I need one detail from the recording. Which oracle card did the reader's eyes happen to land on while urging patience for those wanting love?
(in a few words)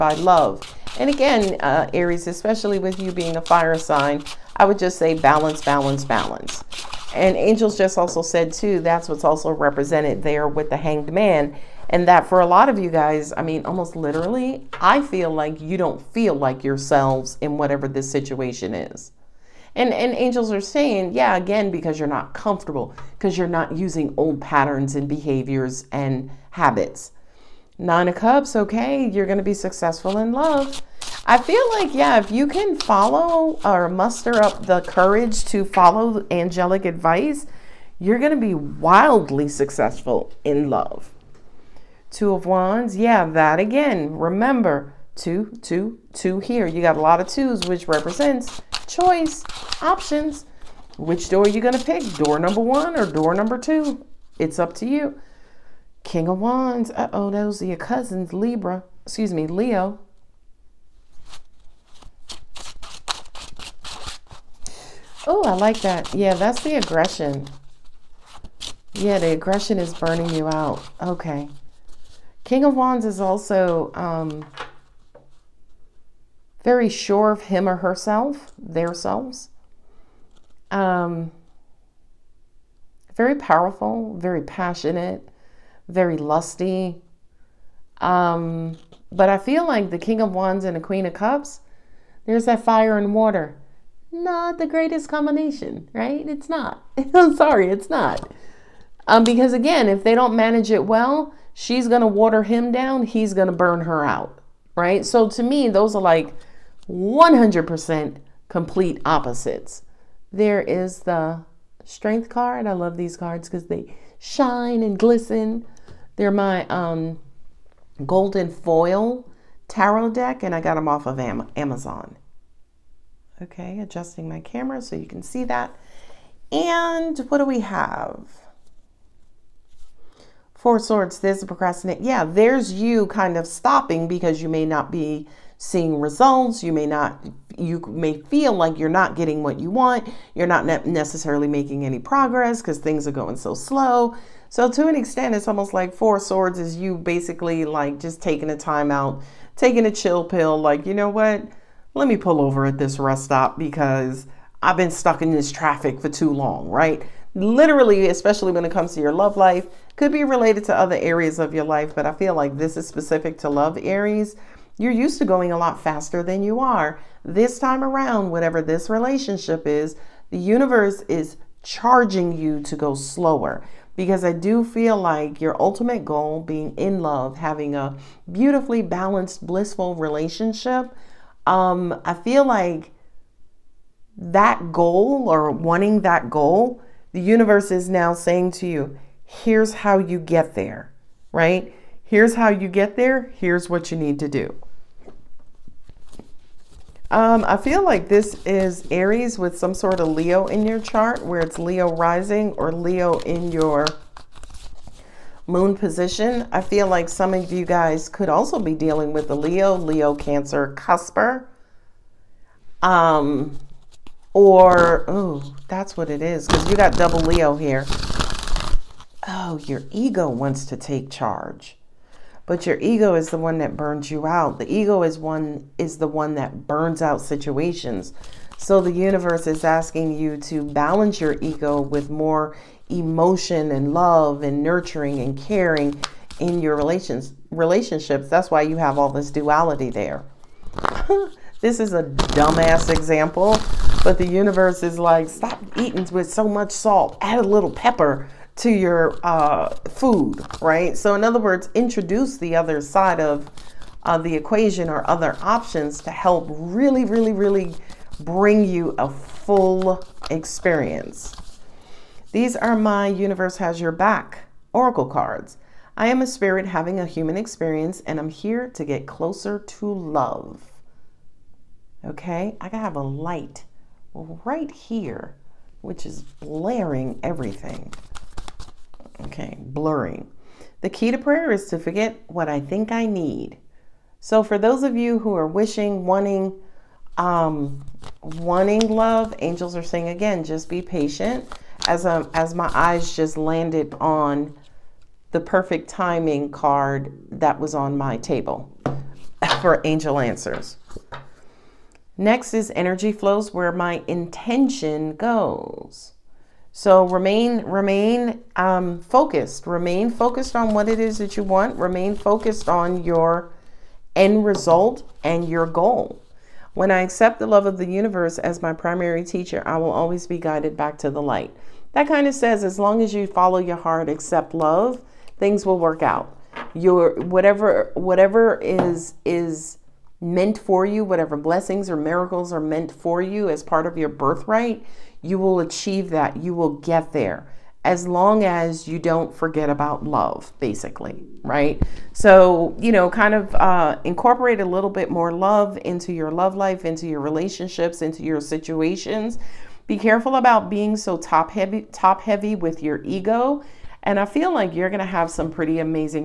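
Perfect timing.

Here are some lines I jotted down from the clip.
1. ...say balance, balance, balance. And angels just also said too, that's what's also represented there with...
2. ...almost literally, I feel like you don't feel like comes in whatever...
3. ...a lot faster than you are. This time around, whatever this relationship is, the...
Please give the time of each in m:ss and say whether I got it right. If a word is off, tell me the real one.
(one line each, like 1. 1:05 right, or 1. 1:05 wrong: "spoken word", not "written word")
1. 0:04 right
2. 0:13 wrong: "yourselves", not "comes"
3. 2:45 right.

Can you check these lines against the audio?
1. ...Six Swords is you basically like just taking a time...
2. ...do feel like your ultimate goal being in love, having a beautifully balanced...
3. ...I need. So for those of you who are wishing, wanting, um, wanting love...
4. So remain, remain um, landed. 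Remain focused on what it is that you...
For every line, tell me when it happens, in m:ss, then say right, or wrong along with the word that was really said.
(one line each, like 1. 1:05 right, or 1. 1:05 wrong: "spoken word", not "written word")
1. 2:25 wrong: "Four", not "Six"
2. 2:54 right
3. 4:42 right
4. 5:06 wrong: "focused", not "landed".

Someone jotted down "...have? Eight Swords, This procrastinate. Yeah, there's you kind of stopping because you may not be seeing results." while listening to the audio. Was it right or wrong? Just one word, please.
wrong.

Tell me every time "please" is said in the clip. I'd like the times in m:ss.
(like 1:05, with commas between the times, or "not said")
not said.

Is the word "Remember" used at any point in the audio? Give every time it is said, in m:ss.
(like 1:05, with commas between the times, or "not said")
0:44.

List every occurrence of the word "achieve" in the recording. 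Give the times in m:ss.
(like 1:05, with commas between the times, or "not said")
5:35.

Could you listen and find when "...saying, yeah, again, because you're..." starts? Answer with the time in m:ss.
0:20.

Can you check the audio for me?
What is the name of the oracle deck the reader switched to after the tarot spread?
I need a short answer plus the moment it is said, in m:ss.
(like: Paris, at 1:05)
Universe Has Your Back, at 4:23.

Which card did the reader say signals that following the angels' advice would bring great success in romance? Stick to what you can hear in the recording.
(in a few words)
Nine of Cups.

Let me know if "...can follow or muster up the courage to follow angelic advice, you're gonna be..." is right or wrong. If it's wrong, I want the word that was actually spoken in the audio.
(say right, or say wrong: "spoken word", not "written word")
right.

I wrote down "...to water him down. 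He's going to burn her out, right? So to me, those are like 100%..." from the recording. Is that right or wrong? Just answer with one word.
right.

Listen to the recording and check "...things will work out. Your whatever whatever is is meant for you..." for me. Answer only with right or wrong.
right.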